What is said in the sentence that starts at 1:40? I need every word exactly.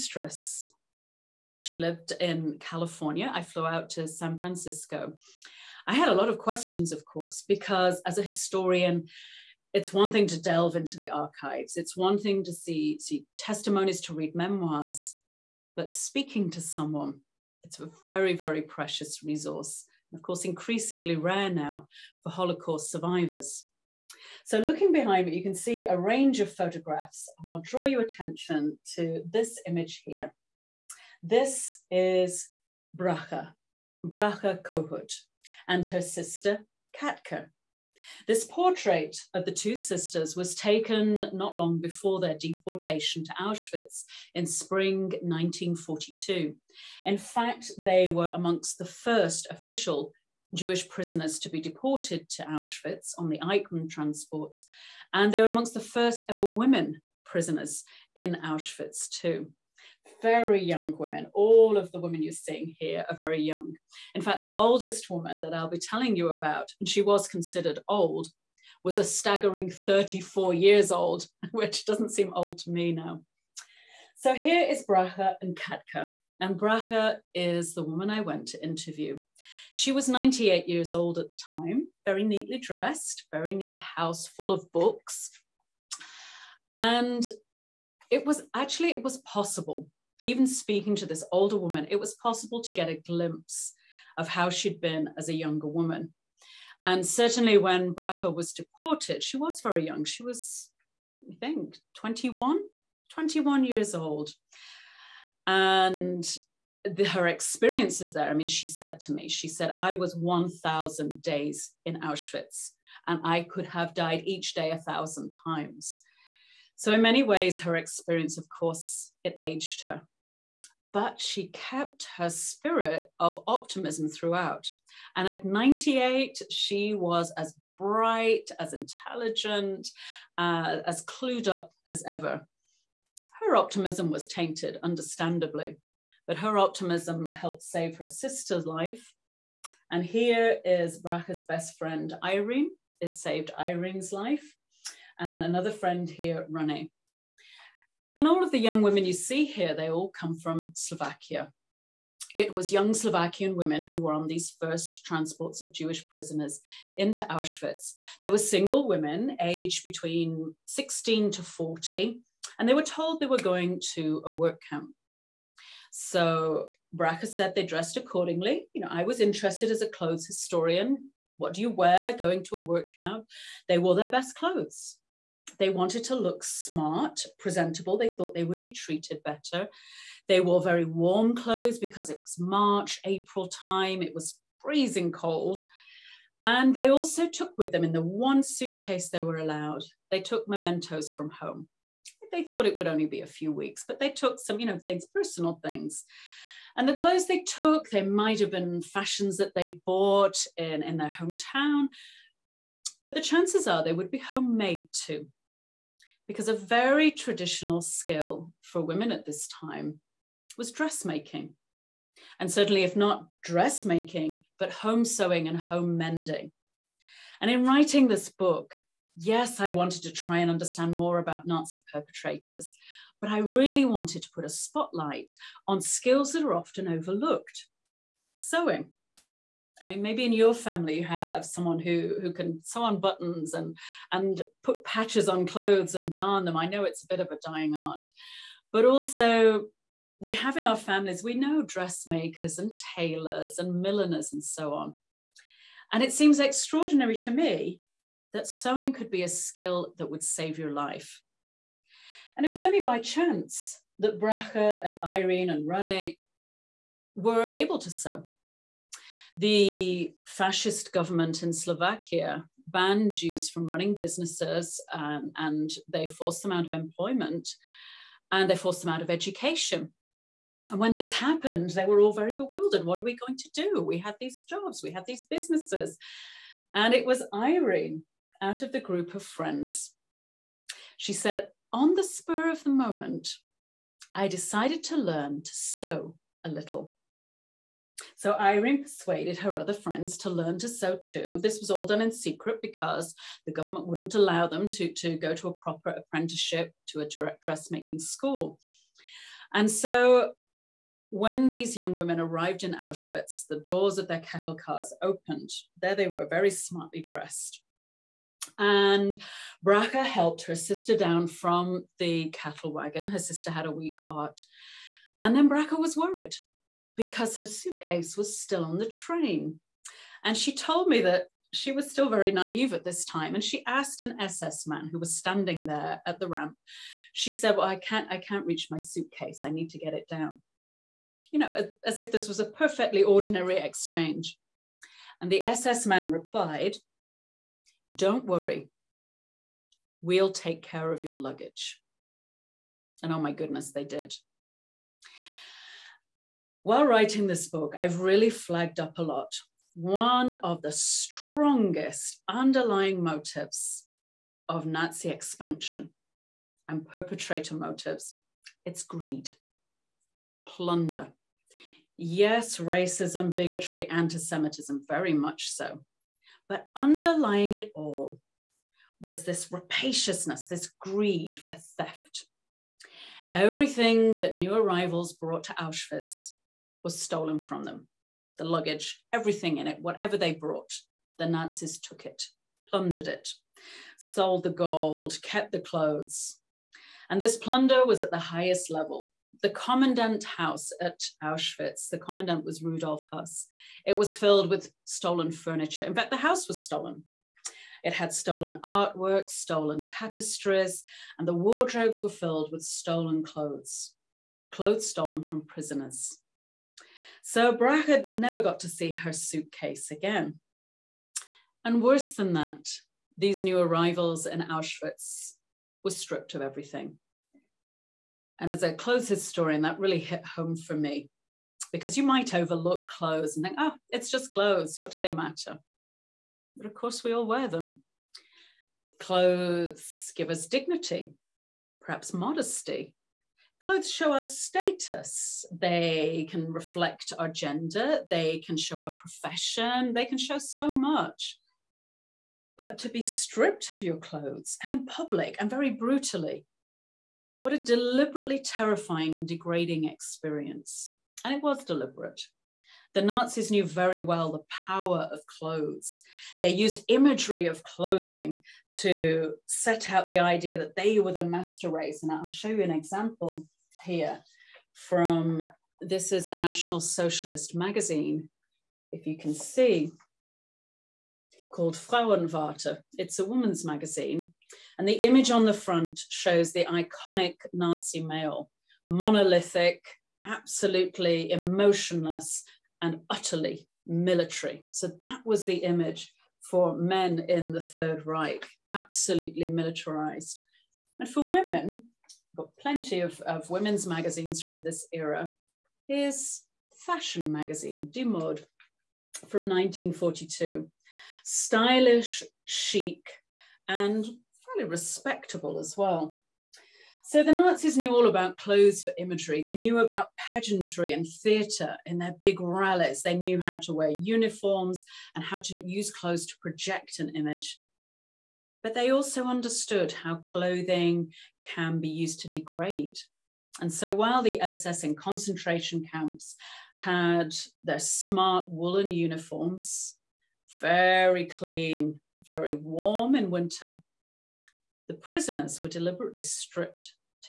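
She was, I think, 21, 21 years old.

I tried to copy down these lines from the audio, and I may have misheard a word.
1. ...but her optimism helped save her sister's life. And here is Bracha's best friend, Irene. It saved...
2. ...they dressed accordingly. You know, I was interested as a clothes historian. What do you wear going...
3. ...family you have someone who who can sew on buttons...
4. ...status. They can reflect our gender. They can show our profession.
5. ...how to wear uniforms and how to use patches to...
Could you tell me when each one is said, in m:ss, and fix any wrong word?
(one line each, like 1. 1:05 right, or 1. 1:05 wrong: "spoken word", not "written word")
1. 2:16 right
2. 2:47 right
3. 3:50 right
4. 7:14 right
5. 8:33 wrong: "clothes", not "patches".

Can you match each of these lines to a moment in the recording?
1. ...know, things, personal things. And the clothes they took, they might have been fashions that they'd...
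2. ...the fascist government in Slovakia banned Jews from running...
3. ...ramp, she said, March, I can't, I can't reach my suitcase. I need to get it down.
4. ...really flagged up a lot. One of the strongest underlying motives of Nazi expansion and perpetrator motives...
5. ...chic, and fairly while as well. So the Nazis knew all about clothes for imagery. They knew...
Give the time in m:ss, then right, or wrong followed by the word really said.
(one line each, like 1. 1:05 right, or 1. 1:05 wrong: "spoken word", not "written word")
1. 3:14 right
2. 4:19 right
3. 5:26 wrong: "Well", not "March"
4. 5:48 right
5. 8:22 wrong: "respectable", not "while".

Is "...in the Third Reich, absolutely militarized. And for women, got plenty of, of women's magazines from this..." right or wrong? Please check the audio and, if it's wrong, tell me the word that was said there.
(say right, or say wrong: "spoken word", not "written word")
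right.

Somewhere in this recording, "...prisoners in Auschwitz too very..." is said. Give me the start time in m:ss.
0:57.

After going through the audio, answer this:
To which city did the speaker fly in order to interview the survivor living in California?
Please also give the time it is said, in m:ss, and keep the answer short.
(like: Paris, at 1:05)
San Francisco, at 0:04.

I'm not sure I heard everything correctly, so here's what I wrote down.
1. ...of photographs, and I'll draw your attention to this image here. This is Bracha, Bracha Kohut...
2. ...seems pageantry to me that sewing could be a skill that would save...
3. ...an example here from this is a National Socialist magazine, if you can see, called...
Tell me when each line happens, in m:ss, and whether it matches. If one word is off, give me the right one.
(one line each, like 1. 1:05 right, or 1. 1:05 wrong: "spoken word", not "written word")
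1. 0:26 right
2. 4:06 wrong: "extraordinary", not "pageantry"
3. 7:42 right.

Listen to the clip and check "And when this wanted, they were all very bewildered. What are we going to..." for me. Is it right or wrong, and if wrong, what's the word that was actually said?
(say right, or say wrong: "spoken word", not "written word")
wrong: "happened", not "wanted".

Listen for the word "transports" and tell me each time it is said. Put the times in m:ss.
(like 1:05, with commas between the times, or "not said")
0:53, 2:35.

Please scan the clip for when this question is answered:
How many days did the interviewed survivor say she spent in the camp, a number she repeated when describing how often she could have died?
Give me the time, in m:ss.
1:50.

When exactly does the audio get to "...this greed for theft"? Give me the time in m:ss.
6:10.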